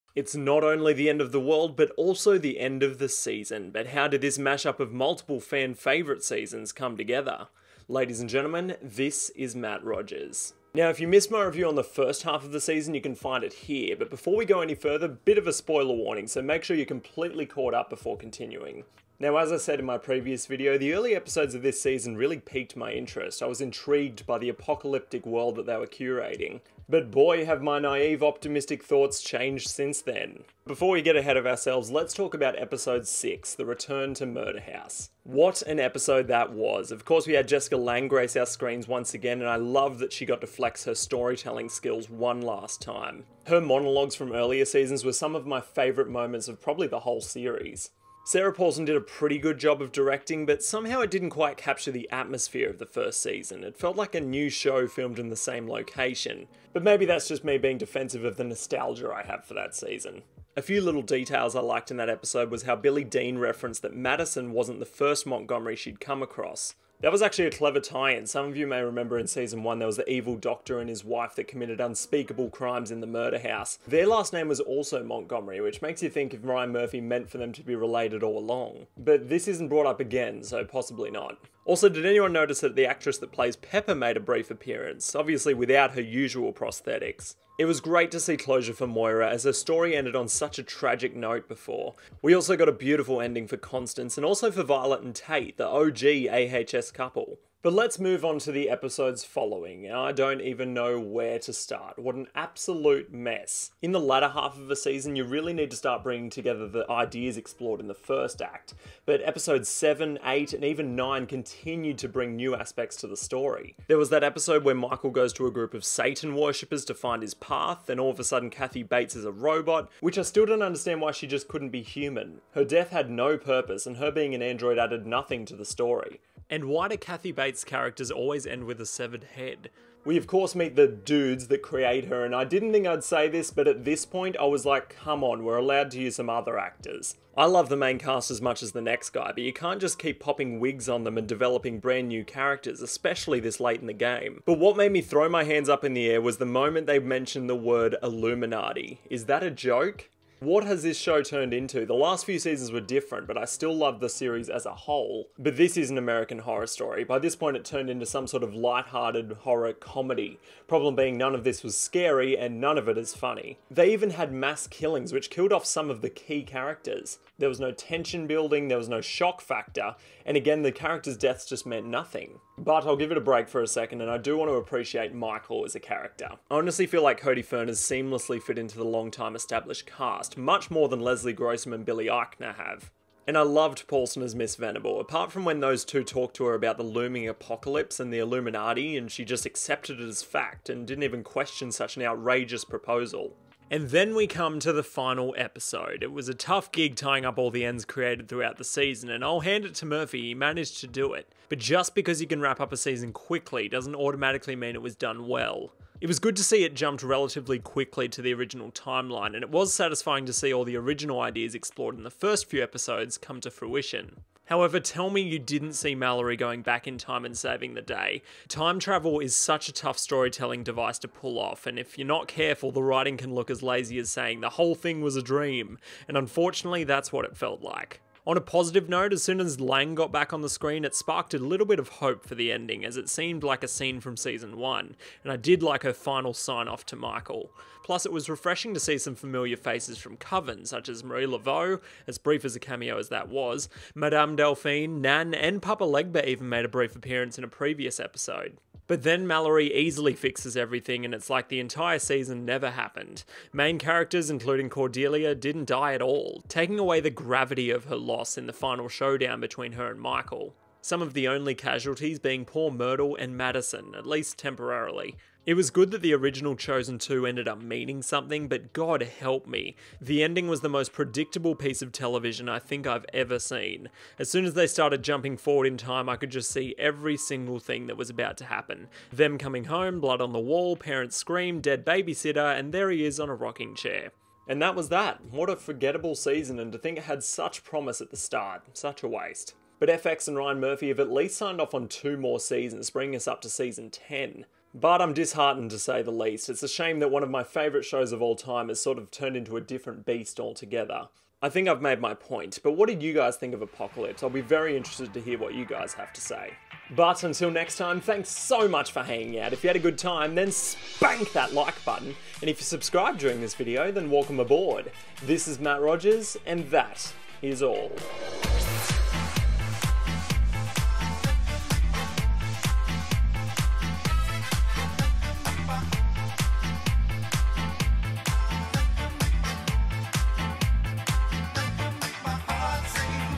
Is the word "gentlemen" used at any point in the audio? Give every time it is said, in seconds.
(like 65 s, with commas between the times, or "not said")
8 s.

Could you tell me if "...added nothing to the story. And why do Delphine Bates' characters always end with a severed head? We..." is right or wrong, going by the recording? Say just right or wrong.
wrong.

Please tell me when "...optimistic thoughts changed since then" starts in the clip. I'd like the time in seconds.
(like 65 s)
28 s.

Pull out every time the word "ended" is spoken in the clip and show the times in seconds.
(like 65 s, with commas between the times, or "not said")
89 s, 267 s.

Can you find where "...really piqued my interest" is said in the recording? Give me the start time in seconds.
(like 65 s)
22 s.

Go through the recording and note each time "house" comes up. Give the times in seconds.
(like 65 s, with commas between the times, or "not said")
34 s, 73 s.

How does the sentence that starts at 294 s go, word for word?
But I'm disheartened to say the least.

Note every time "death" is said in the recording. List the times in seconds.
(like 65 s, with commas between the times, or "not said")
122 s, 171 s.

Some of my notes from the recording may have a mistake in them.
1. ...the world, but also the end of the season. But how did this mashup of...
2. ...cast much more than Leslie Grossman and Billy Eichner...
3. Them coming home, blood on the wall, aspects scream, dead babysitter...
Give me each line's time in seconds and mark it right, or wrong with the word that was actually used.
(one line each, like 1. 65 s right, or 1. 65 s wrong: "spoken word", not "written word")
1. 1 s right
2. 180 s right
3. 279 s wrong: "parents", not "aspects".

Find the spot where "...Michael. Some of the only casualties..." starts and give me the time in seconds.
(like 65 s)
260 s.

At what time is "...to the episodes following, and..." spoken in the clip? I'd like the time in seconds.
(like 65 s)
98 s.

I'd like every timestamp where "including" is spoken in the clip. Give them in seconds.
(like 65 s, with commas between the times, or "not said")
254 s.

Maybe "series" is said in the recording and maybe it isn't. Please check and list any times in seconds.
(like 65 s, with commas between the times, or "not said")
47 s, 154 s.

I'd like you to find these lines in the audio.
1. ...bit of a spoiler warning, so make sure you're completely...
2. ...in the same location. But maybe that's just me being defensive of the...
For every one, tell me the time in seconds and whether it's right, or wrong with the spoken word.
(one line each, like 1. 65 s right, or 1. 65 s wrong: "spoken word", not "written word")
1. 15 s right
2. 55 s right.